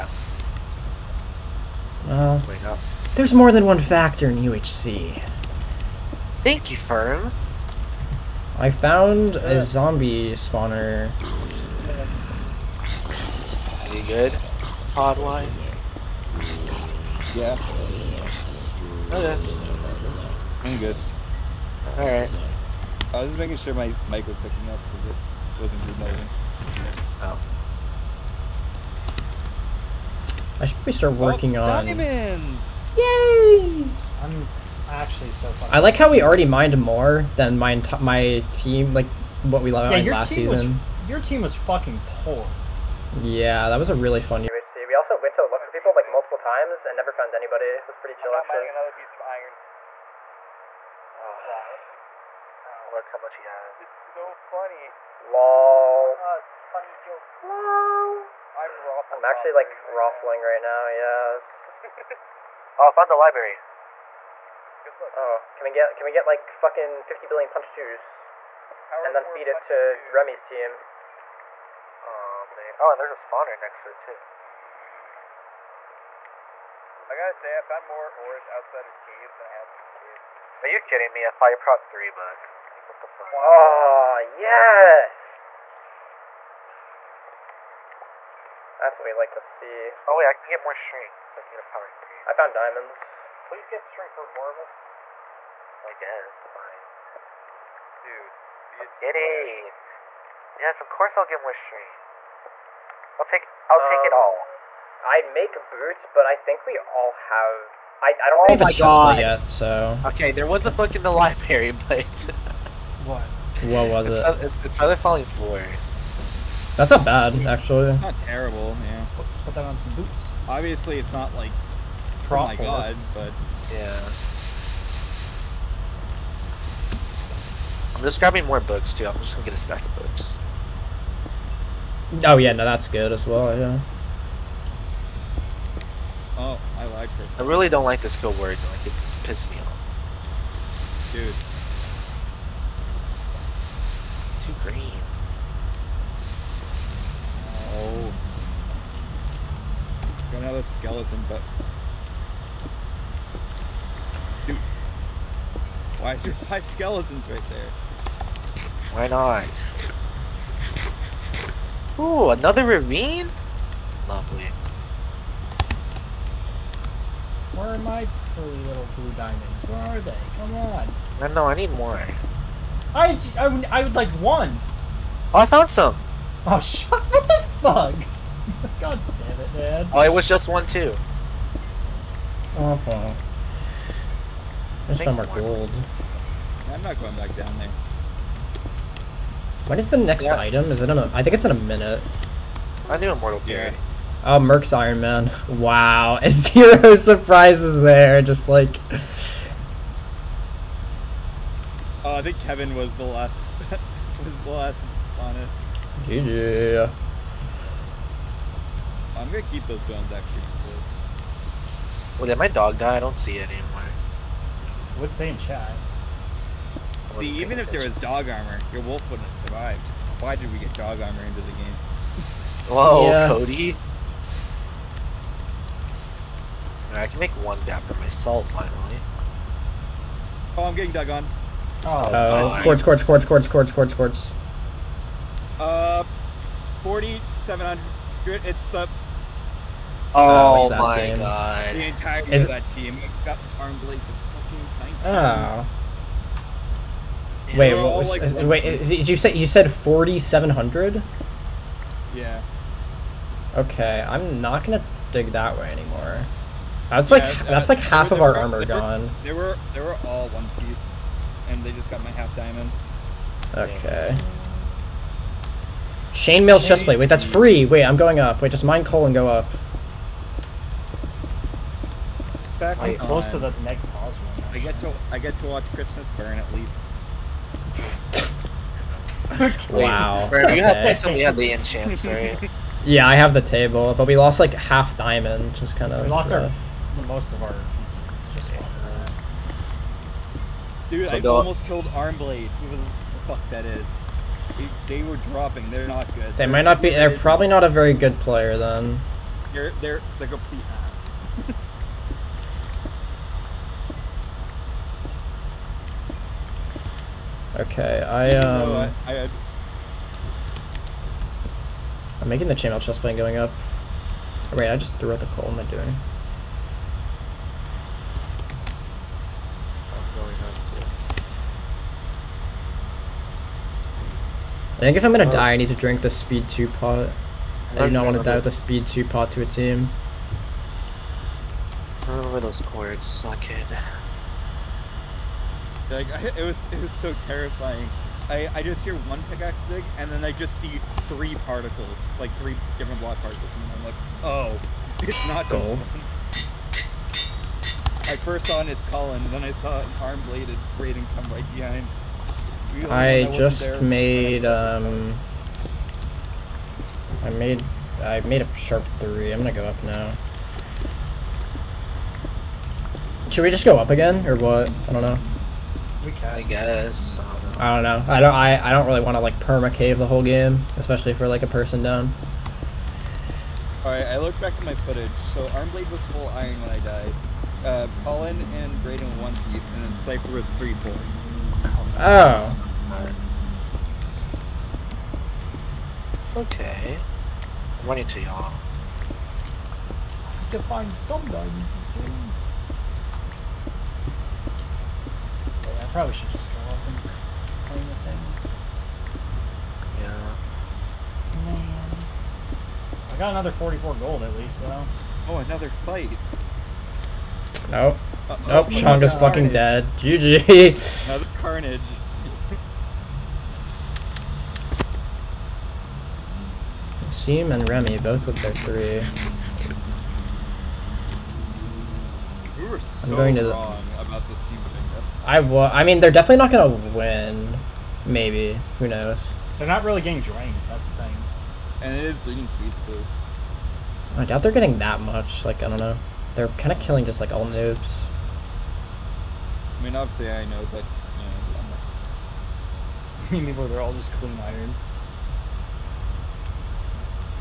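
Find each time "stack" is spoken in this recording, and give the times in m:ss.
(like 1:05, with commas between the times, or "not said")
2:09.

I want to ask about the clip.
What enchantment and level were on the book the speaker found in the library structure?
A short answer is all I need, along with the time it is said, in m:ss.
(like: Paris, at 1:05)
Feather Falling 4, at 1:54.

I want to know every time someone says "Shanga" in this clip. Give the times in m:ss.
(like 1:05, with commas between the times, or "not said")
6:48.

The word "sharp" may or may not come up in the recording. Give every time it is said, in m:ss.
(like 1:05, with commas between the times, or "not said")
5:58.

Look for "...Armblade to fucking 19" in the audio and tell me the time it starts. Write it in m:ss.
4:03.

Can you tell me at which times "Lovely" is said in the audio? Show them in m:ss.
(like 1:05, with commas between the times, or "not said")
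2:44.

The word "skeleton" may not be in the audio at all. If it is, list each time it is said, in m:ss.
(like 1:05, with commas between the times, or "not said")
2:30, 2:36.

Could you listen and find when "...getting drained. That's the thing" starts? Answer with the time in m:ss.
7:10.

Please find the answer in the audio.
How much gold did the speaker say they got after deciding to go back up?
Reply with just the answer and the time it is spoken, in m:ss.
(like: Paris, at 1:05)
44, at 6:43.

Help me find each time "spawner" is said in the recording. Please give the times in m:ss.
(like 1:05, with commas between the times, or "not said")
0:10, 1:13.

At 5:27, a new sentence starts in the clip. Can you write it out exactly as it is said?
I do not want to die with the speed 2 pot to a team.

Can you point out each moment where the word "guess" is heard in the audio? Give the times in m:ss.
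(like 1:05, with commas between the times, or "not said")
1:35, 6:06.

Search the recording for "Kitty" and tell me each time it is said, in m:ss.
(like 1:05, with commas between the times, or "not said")
1:38.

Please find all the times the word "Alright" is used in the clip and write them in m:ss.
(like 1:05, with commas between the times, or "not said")
0:21.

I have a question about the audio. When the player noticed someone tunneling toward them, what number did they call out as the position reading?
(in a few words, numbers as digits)
4,700.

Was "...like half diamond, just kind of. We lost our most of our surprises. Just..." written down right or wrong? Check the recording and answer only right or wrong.
wrong.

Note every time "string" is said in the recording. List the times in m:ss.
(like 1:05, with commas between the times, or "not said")
1:30.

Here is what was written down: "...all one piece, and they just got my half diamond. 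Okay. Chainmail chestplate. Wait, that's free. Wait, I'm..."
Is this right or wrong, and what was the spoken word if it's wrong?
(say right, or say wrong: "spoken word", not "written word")
right.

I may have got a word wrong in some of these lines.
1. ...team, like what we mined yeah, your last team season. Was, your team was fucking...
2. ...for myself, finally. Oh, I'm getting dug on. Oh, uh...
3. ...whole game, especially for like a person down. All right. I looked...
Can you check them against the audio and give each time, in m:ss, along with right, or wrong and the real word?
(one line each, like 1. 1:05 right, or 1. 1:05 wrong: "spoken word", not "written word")
1. 0:38 right
2. 3:47 right
3. 6:10 right.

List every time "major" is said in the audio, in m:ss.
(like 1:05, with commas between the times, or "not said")
not said.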